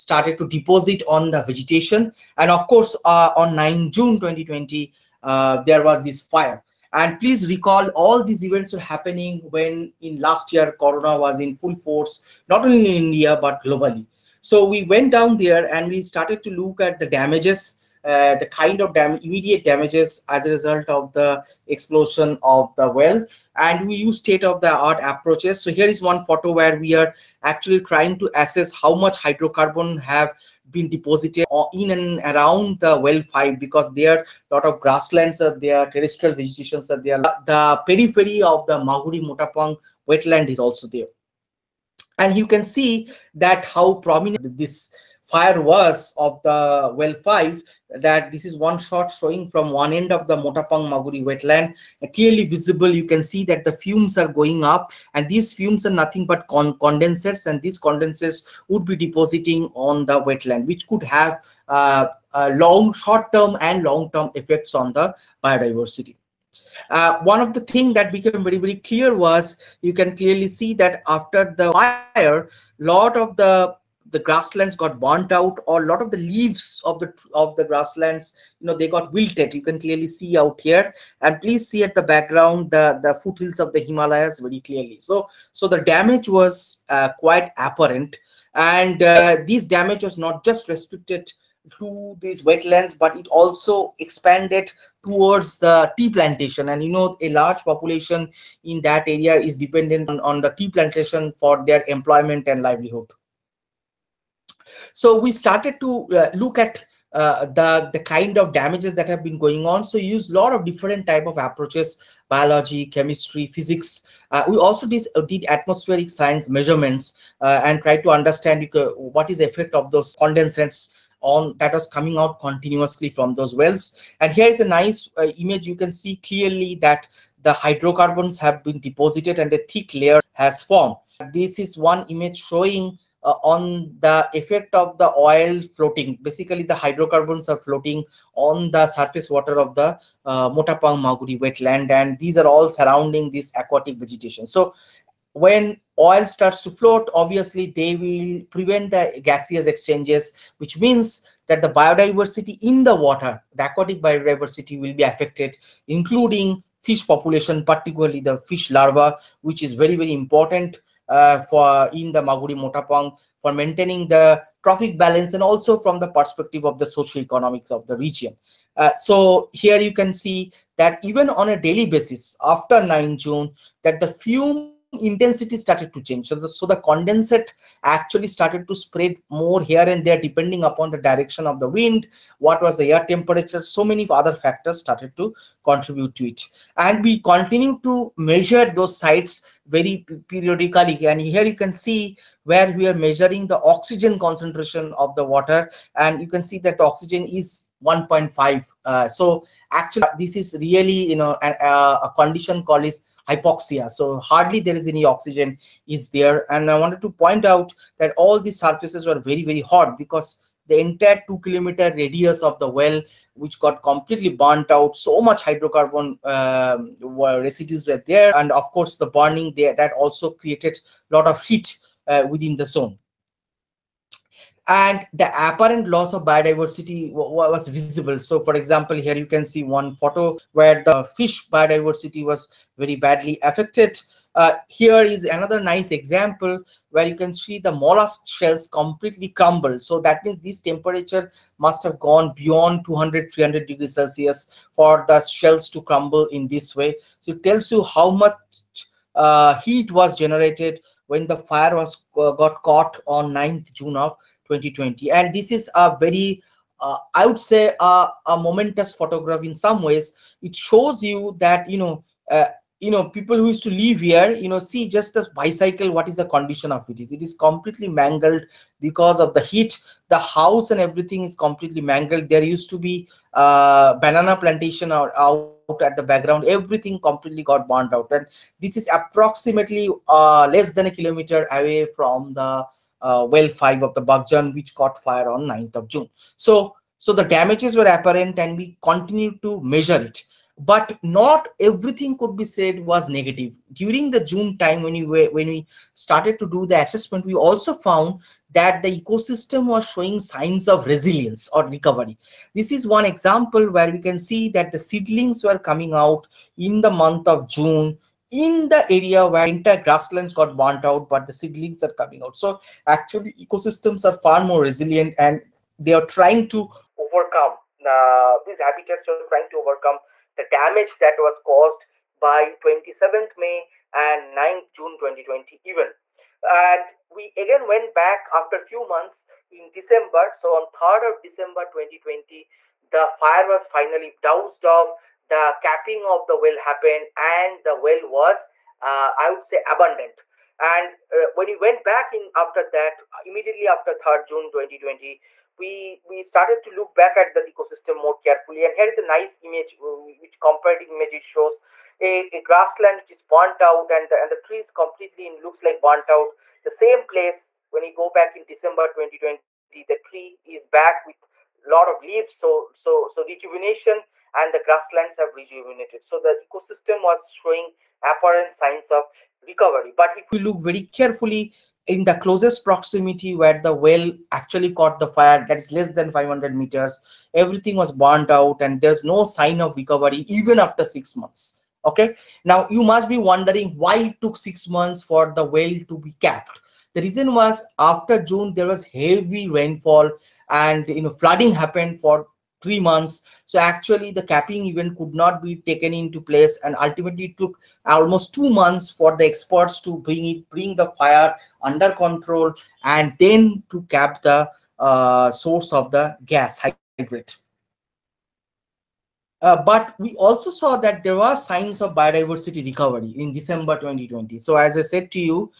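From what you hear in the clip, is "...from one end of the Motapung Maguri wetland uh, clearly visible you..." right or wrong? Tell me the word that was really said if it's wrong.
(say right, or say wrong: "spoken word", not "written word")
right.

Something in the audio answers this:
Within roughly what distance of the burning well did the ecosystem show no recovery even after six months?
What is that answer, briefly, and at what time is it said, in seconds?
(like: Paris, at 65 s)
500 meters, at 376 s.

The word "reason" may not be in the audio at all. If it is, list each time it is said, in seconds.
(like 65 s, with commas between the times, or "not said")
387 s.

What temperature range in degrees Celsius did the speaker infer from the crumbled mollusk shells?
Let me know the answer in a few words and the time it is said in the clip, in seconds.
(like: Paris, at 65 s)
200-300 degrees Celsius, at 242 s.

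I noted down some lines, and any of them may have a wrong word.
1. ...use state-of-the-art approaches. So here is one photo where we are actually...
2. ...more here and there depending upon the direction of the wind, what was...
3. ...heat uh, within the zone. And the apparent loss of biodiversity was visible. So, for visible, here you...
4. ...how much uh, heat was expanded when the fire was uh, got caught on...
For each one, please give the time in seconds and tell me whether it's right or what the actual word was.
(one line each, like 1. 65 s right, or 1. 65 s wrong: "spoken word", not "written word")
1. 23 s right
2. 179 s right
3. 221 s wrong: "example", not "visible"
4. 247 s wrong: "generated", not "expanded".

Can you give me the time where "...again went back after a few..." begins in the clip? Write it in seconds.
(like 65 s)
327 s.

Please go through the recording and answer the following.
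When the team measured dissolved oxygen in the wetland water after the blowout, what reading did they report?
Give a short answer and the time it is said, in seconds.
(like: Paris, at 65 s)
1.5, at 197 s.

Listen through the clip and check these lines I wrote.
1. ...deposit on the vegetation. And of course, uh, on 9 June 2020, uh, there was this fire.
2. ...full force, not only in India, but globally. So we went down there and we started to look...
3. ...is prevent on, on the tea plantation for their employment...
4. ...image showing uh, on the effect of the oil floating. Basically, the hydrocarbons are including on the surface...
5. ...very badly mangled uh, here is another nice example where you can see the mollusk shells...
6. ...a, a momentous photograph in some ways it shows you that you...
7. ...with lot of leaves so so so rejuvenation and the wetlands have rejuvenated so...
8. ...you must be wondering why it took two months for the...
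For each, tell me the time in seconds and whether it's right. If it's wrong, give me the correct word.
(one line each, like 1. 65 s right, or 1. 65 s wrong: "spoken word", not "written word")
1. 0 s right
2. 11 s right
3. 99 s wrong: "dependent", not "prevent"
4. 132 s wrong: "floating", not "including"
5. 232 s wrong: "affected", not "mangled"
6. 257 s right
7. 361 s wrong: "grasslands", not "wetlands"
8. 382 s wrong: "six", not "two".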